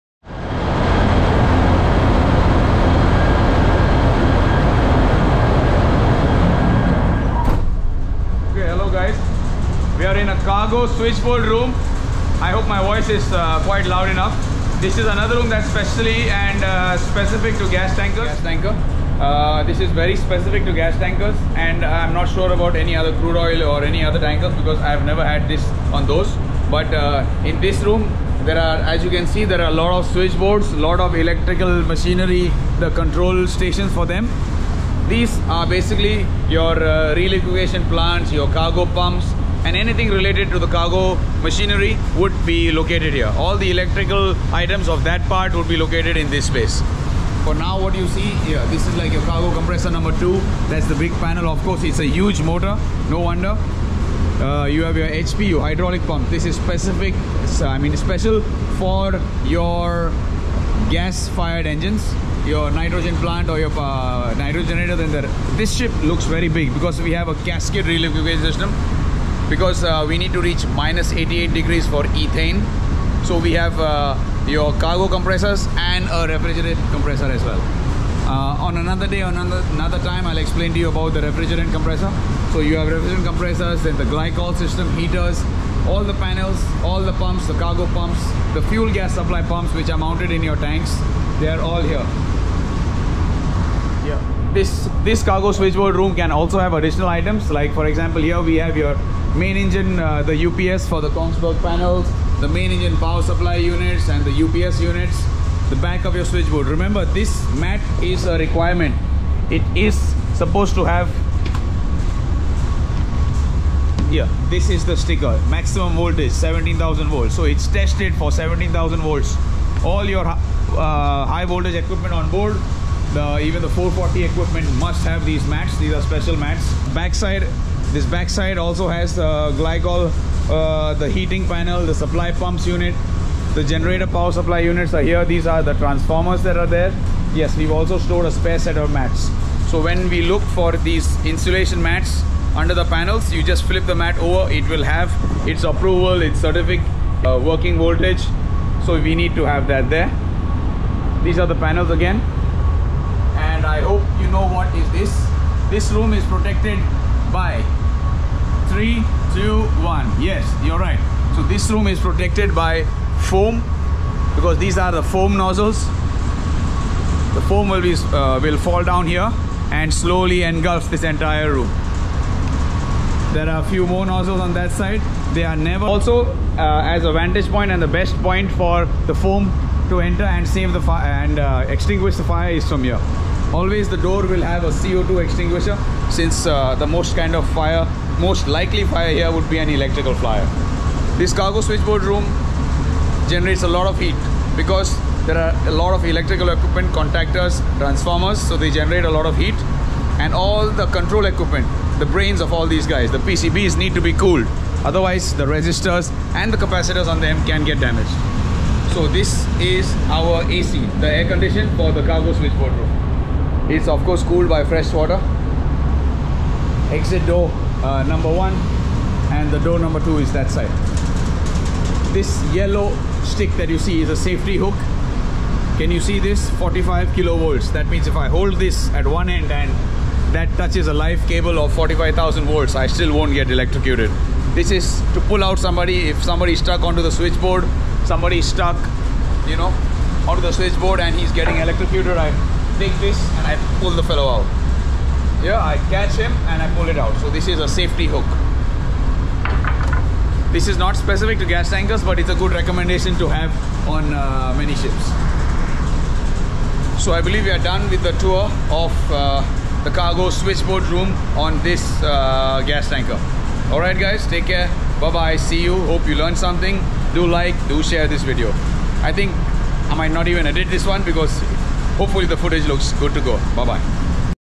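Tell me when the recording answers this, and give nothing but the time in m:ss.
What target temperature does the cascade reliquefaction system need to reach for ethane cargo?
1:10.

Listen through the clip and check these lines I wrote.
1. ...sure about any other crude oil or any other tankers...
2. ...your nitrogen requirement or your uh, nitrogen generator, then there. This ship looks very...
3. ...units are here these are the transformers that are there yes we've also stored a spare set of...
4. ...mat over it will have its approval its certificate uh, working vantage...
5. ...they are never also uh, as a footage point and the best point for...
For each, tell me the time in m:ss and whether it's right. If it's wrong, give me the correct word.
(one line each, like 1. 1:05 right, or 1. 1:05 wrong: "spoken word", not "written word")
1. 0:22 right
2. 1:02 wrong: "plant", not "requirement"
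3. 2:14 right
4. 2:23 wrong: "voltage", not "vantage"
5. 2:55 wrong: "vantage", not "footage".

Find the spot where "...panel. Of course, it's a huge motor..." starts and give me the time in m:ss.
0:51.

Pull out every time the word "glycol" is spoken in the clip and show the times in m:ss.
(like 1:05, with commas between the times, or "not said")
1:24, 2:09.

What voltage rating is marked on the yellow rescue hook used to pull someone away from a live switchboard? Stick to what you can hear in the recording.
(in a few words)
45 kilovolts.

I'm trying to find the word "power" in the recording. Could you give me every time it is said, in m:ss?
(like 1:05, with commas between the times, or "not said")
1:42, 2:14.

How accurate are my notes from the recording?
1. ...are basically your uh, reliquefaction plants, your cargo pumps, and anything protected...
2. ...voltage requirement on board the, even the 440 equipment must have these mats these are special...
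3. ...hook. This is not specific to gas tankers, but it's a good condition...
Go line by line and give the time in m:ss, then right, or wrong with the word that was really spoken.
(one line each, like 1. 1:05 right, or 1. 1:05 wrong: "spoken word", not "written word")
1. 0:35 wrong: "related", not "protected"
2. 2:01 wrong: "equipment", not "requirement"
3. 4:08 wrong: "recommendation", not "condition".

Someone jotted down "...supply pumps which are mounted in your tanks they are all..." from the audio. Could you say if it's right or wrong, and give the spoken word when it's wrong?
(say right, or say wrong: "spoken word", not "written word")
right.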